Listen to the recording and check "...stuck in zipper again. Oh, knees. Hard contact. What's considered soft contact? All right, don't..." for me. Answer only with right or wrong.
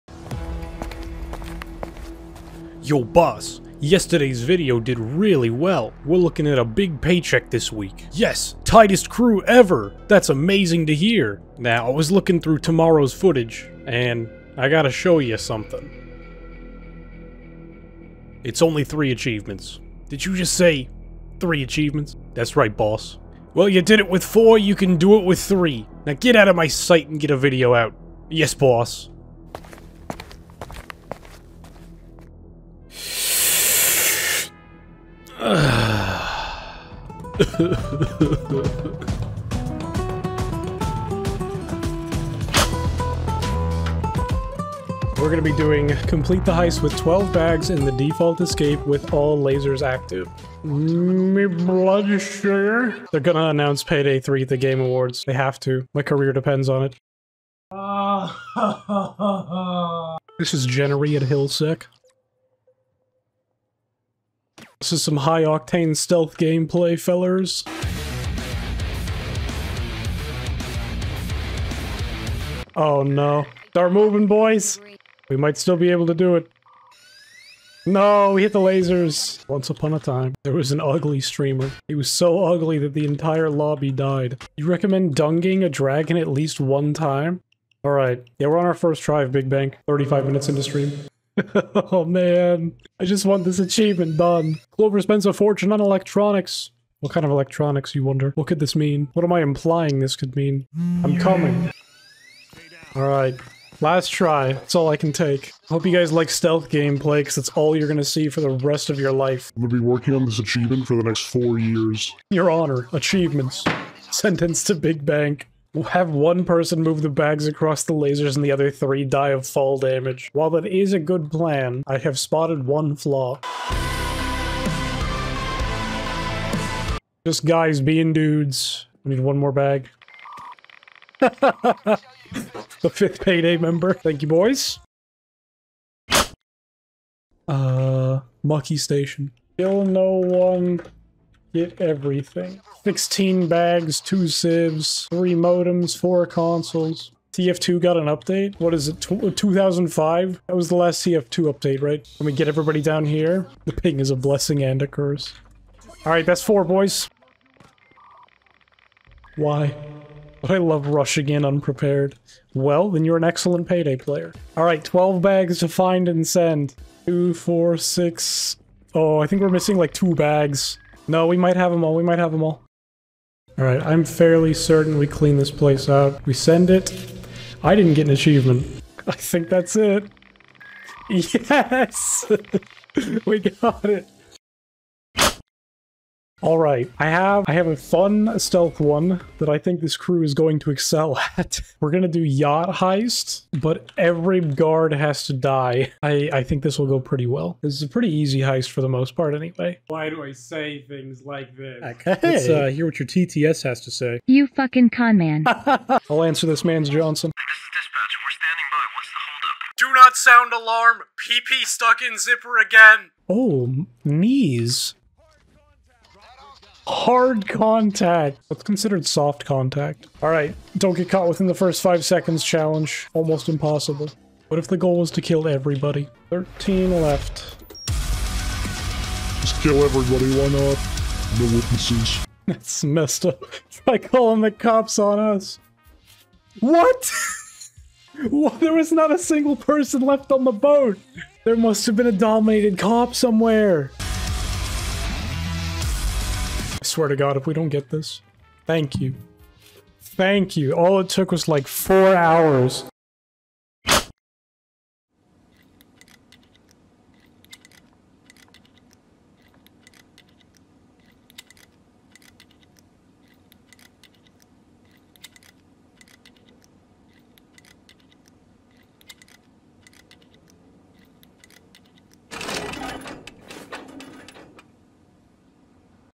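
right.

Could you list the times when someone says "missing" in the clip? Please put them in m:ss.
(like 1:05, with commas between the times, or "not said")
2:49.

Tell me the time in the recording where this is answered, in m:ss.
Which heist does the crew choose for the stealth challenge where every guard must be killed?
3:12.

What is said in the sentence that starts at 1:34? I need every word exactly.
Clover spends a fortune on electronics.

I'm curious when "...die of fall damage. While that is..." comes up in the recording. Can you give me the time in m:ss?
1:59.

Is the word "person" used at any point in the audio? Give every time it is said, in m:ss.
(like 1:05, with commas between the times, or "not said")
1:56, 3:59.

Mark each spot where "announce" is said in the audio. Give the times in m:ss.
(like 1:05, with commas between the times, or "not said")
0:53.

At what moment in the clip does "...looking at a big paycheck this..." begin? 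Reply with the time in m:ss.
0:06.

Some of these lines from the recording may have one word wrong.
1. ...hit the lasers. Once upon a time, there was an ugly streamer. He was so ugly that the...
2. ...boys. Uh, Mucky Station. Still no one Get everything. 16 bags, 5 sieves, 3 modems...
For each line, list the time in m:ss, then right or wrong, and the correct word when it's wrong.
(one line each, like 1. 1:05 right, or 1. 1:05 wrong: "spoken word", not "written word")
1. 1:18 right
2. 2:14 wrong: "2", not "5".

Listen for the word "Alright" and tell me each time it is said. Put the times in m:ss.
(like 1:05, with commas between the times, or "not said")
1:27, 1:42, 2:36, 2:44.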